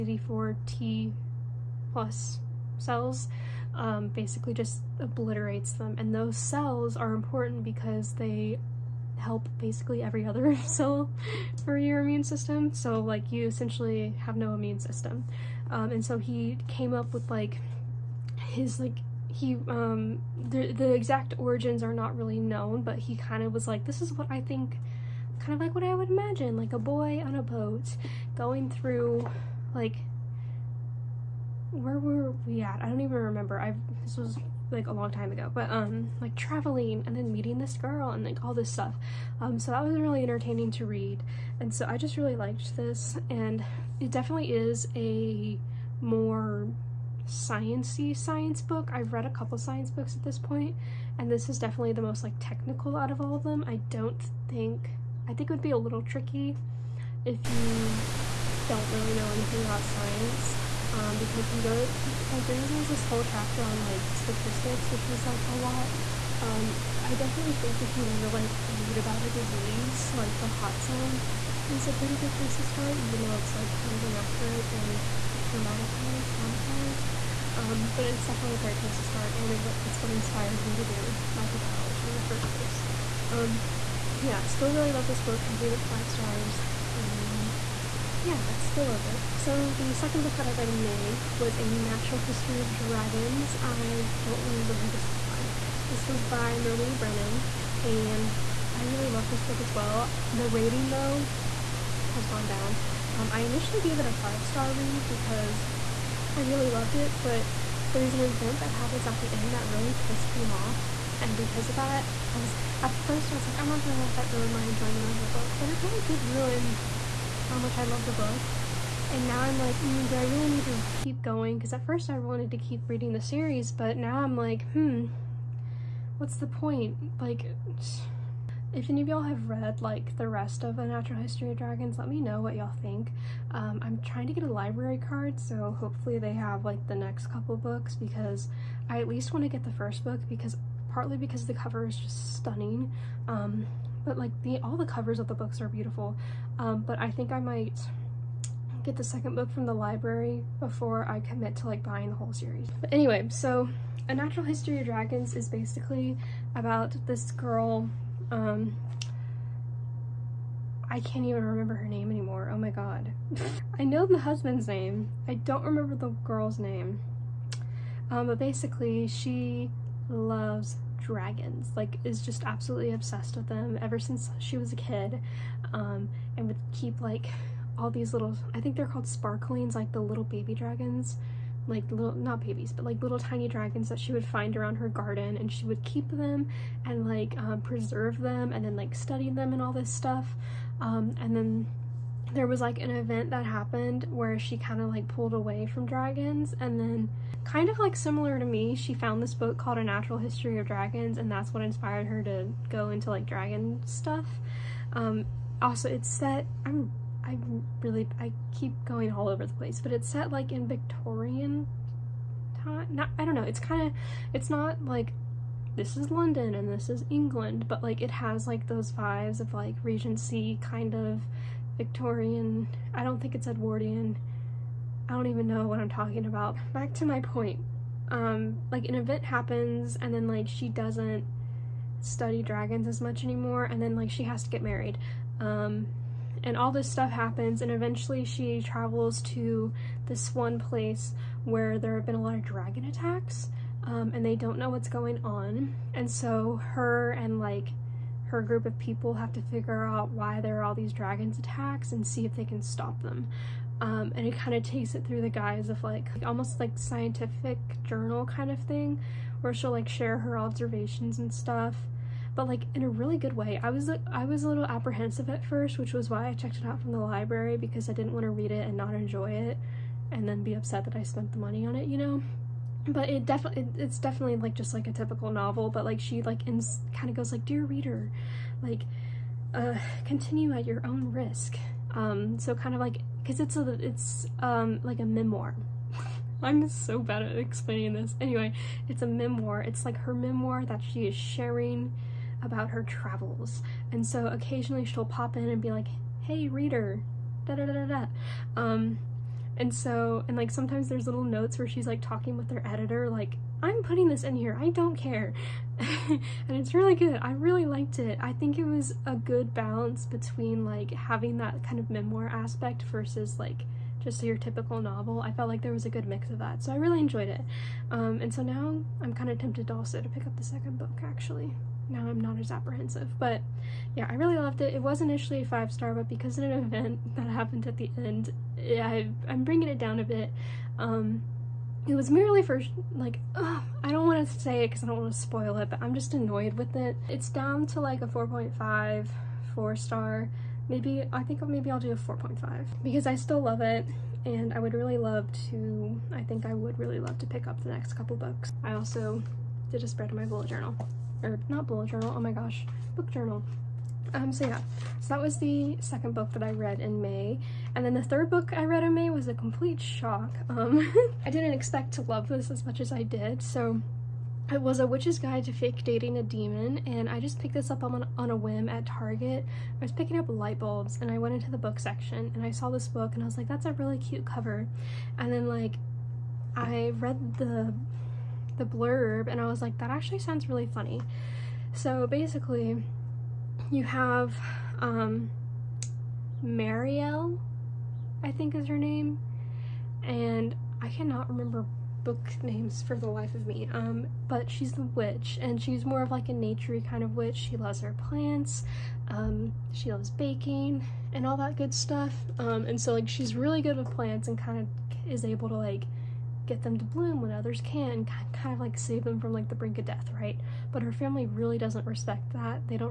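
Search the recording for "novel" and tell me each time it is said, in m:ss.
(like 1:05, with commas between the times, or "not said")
4:35, 5:14.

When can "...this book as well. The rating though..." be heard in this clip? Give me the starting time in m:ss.
1:39.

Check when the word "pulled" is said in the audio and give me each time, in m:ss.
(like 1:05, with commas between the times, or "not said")
3:15.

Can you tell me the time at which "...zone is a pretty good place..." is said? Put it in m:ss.
1:10.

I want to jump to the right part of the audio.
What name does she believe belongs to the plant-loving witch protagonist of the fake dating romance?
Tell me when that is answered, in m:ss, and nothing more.
6:26.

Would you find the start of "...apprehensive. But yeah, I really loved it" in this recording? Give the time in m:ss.
5:22.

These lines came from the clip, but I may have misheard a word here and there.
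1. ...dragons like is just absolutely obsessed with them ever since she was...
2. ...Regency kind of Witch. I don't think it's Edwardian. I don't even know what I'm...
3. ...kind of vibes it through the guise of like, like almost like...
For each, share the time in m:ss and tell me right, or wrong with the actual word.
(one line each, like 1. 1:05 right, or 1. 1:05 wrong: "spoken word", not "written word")
1. 2:51 right
2. 3:39 wrong: "Victorian", not "Witch"
3. 4:14 wrong: "takes", not "vibes".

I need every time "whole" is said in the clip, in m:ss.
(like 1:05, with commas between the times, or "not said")
1:03, 2:32.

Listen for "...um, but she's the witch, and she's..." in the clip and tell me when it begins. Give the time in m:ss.
6:33.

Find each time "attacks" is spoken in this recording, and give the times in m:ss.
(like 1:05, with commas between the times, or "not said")
4:02, 4:11.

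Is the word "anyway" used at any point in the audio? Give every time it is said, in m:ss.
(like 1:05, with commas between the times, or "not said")
2:32, 4:48.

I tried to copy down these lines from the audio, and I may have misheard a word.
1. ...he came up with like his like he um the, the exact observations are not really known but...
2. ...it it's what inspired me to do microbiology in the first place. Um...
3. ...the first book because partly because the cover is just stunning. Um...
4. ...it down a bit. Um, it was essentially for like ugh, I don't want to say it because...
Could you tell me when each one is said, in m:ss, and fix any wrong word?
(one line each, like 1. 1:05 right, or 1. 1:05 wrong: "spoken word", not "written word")
1. 0:16 wrong: "origins", not "observations"
2. 1:19 right
3. 2:19 right
4. 5:29 wrong: "merely", not "essentially".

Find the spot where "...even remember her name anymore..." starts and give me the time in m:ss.
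2:41.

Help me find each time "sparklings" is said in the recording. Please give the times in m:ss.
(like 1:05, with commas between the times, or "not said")
2:59.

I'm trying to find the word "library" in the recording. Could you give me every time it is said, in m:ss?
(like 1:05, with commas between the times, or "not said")
2:14, 2:29, 4:26.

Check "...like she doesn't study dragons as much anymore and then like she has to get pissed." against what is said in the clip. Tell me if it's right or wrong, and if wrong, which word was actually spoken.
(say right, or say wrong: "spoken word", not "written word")
wrong: "married", not "pissed".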